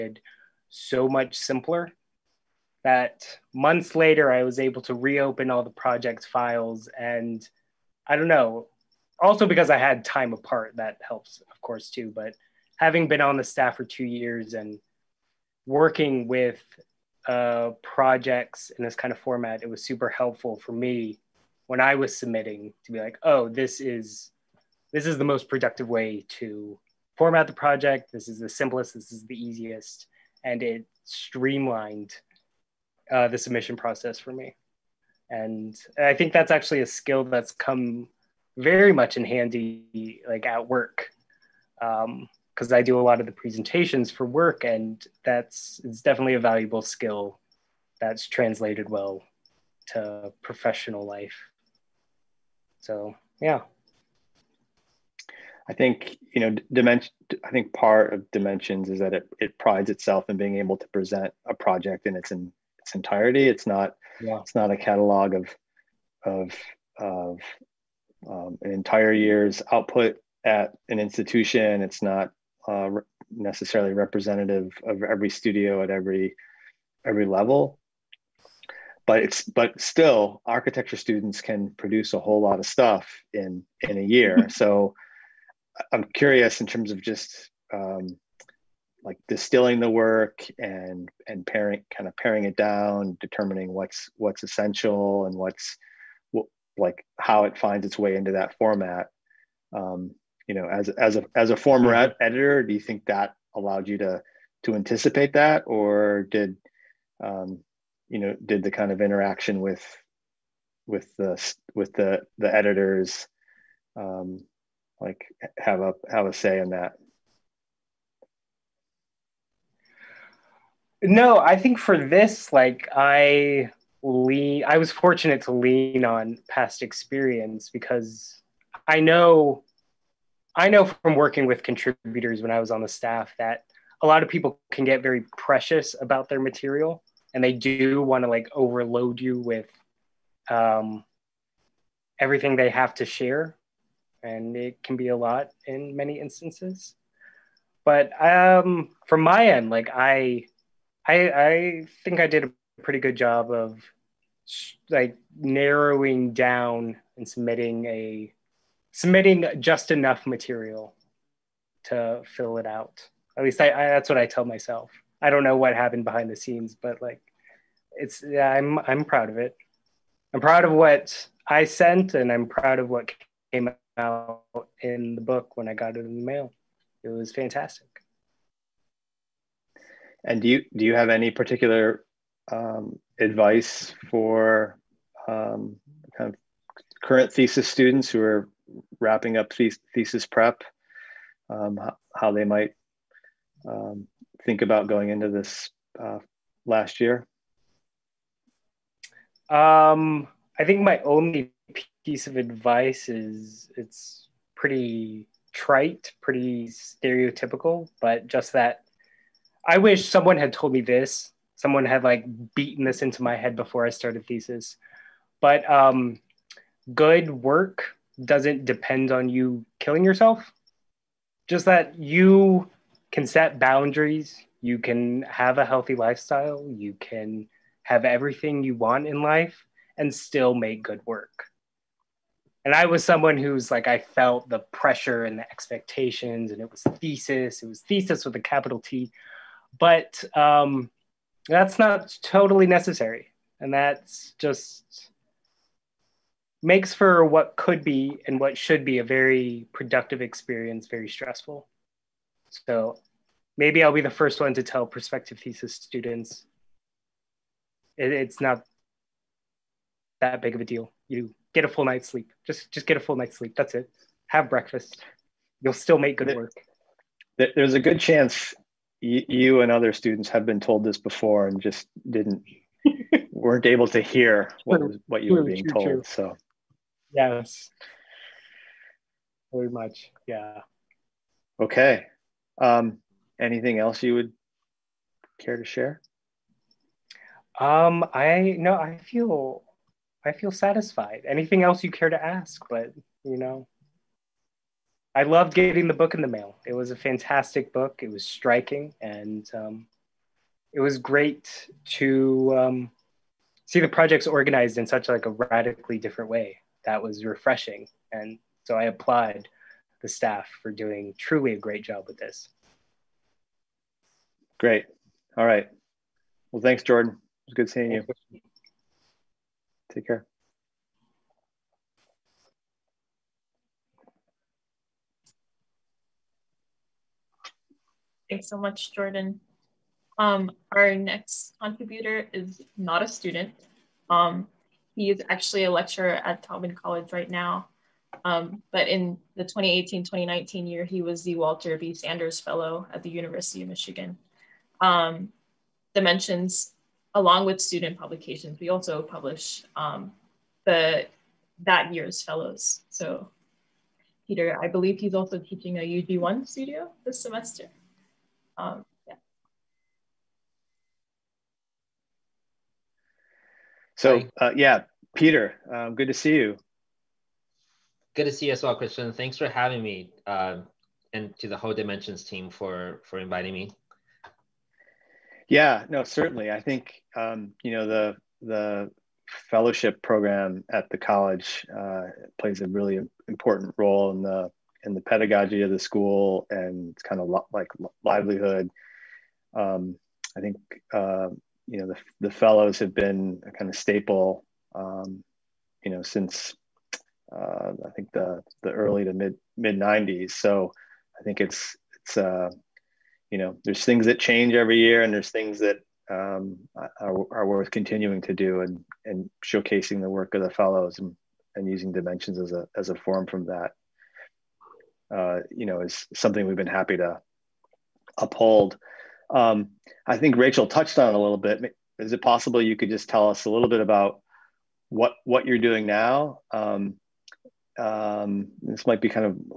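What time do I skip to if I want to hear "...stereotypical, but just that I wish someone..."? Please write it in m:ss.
3:26.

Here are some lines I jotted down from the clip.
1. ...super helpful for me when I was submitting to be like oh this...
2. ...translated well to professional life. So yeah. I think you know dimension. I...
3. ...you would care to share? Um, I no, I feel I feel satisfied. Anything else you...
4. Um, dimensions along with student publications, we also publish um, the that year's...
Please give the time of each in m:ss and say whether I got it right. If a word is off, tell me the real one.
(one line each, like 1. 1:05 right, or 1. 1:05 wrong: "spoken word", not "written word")
1. 0:19 right
2. 0:48 right
3. 4:44 right
4. 5:44 right.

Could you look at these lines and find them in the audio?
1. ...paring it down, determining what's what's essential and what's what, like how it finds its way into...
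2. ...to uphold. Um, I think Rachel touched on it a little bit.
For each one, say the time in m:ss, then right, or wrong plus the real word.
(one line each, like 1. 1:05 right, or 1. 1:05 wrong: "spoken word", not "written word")
1. 1:32 right
2. 6:56 right.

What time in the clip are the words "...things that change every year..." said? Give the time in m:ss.
6:43.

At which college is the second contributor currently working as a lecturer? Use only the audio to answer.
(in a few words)
Taubman College.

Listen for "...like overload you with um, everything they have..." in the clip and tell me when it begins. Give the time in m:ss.
2:18.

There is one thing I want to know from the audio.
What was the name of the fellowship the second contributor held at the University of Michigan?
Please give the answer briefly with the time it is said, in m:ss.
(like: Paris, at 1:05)
Walter B. Sanders Fellow, at 5:41.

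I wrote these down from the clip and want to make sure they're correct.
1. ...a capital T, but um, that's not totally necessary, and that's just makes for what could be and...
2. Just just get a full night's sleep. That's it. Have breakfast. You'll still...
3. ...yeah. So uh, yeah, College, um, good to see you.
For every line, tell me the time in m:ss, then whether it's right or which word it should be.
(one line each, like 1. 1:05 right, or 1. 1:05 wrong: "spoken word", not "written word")
1. 3:58 right
2. 4:22 right
3. 5:59 wrong: "Peter", not "College".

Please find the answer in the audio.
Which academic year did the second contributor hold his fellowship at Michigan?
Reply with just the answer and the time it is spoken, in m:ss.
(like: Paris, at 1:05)
2018-2019, at 5:39.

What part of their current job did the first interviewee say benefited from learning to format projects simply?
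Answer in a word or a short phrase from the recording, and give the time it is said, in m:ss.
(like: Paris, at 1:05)
presentations, at 0:43.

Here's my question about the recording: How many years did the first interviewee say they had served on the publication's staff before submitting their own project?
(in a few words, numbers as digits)
2.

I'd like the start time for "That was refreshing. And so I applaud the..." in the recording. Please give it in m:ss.
5:06.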